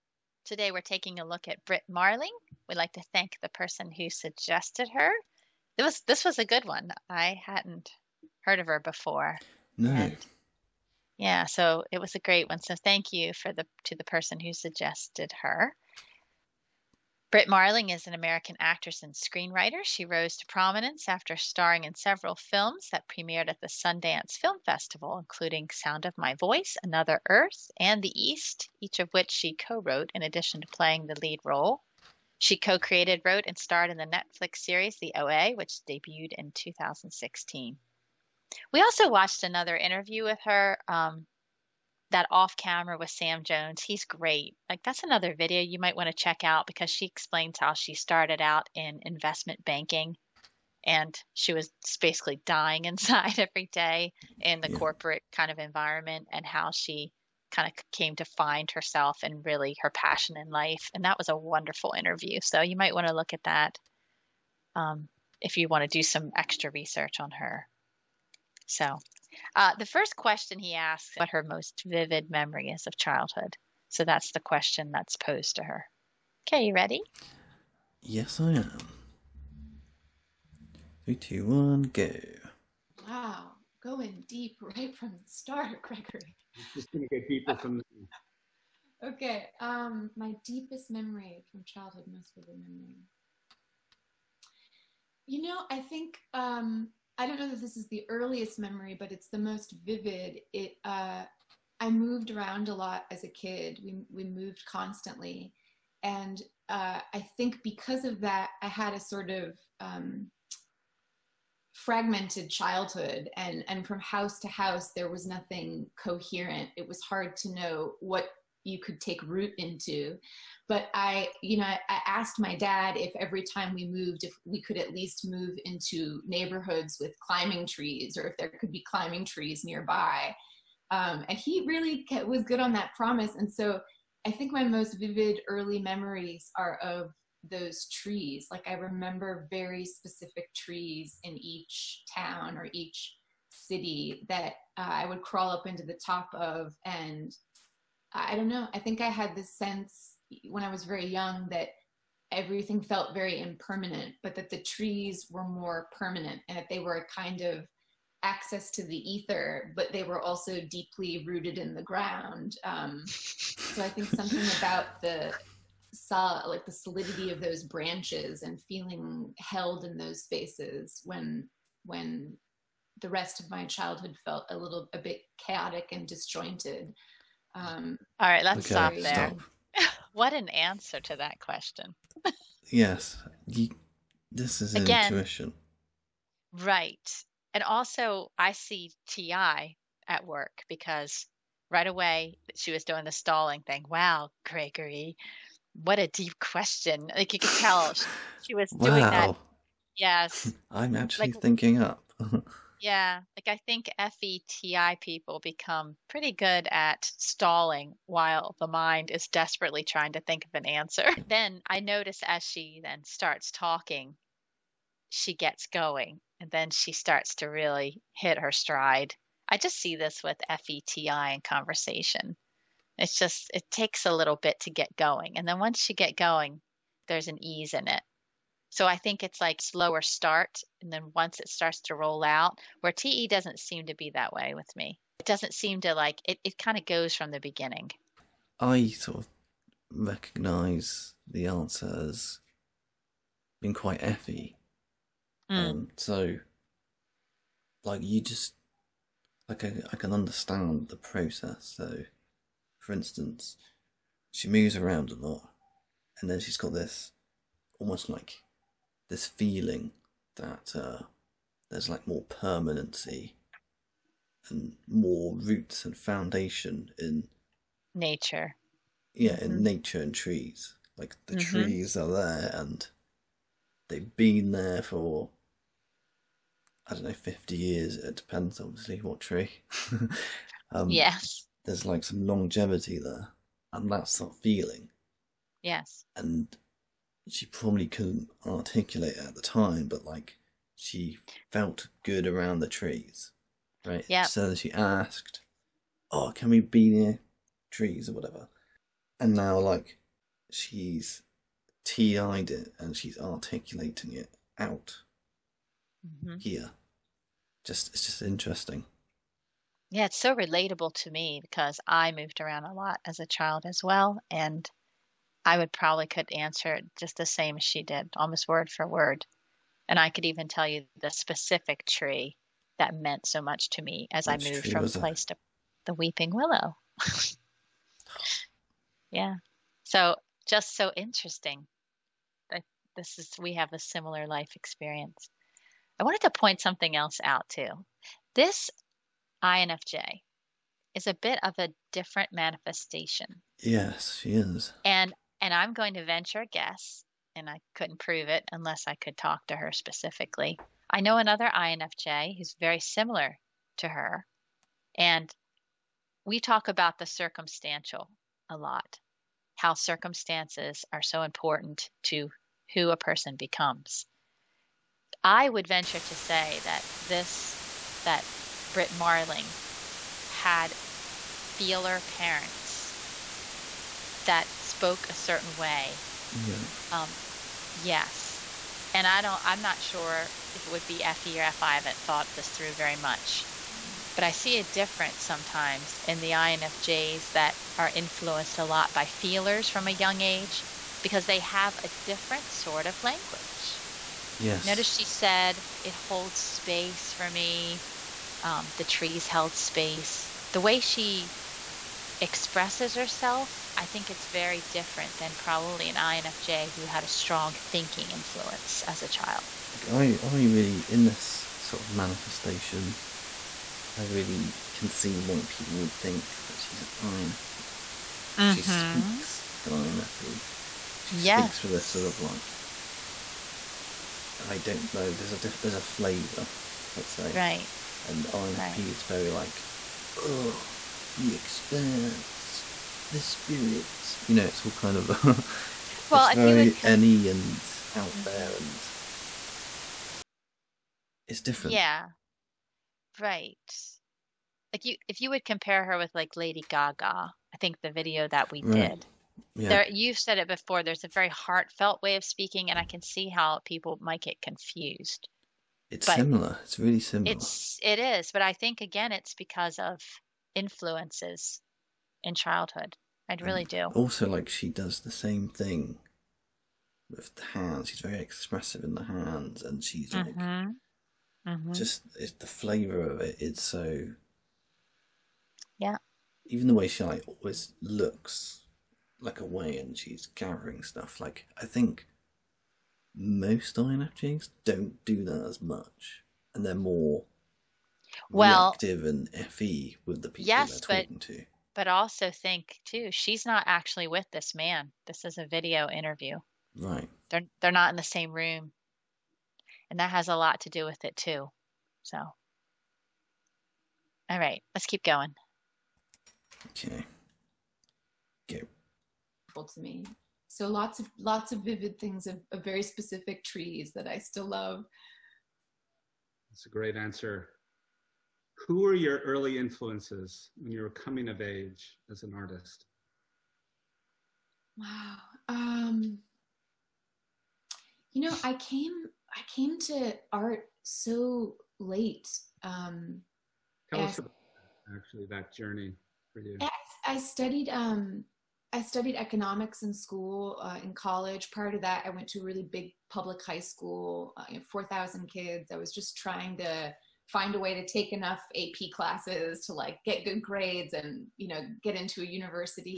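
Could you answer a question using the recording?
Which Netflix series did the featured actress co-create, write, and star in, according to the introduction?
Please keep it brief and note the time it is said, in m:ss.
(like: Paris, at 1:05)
The OA, at 0:34.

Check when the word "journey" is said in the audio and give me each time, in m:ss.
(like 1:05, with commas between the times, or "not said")
8:55.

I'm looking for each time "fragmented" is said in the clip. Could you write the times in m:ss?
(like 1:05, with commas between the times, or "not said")
1:51.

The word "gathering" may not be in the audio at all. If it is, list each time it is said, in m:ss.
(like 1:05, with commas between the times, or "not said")
8:00.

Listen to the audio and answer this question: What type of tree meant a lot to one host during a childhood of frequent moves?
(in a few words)
weeping willow.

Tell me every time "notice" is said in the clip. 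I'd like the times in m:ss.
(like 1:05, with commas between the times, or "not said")
3:31, 6:34.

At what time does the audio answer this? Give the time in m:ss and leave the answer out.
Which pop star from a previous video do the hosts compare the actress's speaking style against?
7:26.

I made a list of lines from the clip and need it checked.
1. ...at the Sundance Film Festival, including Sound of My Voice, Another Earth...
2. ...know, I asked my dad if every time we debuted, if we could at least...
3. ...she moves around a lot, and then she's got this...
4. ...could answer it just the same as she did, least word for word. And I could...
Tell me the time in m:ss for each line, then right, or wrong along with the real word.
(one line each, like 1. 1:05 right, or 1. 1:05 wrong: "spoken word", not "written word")
1. 0:23 right
2. 2:01 wrong: "moved", not "debuted"
3. 4:14 right
4. 5:16 wrong: "almost", not "least".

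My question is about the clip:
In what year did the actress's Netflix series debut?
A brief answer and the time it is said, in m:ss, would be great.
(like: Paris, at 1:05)
2016, at 0:36.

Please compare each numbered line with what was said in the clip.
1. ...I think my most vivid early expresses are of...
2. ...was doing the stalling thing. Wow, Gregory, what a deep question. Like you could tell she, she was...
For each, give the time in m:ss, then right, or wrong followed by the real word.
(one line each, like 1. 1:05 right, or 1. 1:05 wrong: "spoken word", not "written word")
1. 2:14 wrong: "memories", not "expresses"
2. 3:12 right.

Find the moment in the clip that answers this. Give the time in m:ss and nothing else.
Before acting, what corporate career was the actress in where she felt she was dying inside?
0:49.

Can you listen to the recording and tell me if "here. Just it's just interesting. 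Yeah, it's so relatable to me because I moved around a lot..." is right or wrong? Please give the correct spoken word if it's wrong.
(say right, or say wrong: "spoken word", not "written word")
right.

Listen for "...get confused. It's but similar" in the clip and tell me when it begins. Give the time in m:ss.
7:34.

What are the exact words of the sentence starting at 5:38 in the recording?
This INFJ is a bit of a different manifestation.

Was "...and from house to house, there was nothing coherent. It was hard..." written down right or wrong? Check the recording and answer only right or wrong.
right.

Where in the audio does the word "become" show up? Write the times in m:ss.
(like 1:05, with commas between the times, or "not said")
3:25, 6:03.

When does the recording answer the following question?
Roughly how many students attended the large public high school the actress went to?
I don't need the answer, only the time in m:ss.
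9:04.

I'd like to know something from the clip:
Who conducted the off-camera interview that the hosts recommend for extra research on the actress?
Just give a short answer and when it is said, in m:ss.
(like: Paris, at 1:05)
Sam Jones, at 0:43.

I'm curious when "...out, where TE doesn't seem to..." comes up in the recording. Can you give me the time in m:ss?
3:52.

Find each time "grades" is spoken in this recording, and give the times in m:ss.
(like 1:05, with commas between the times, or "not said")
9:10.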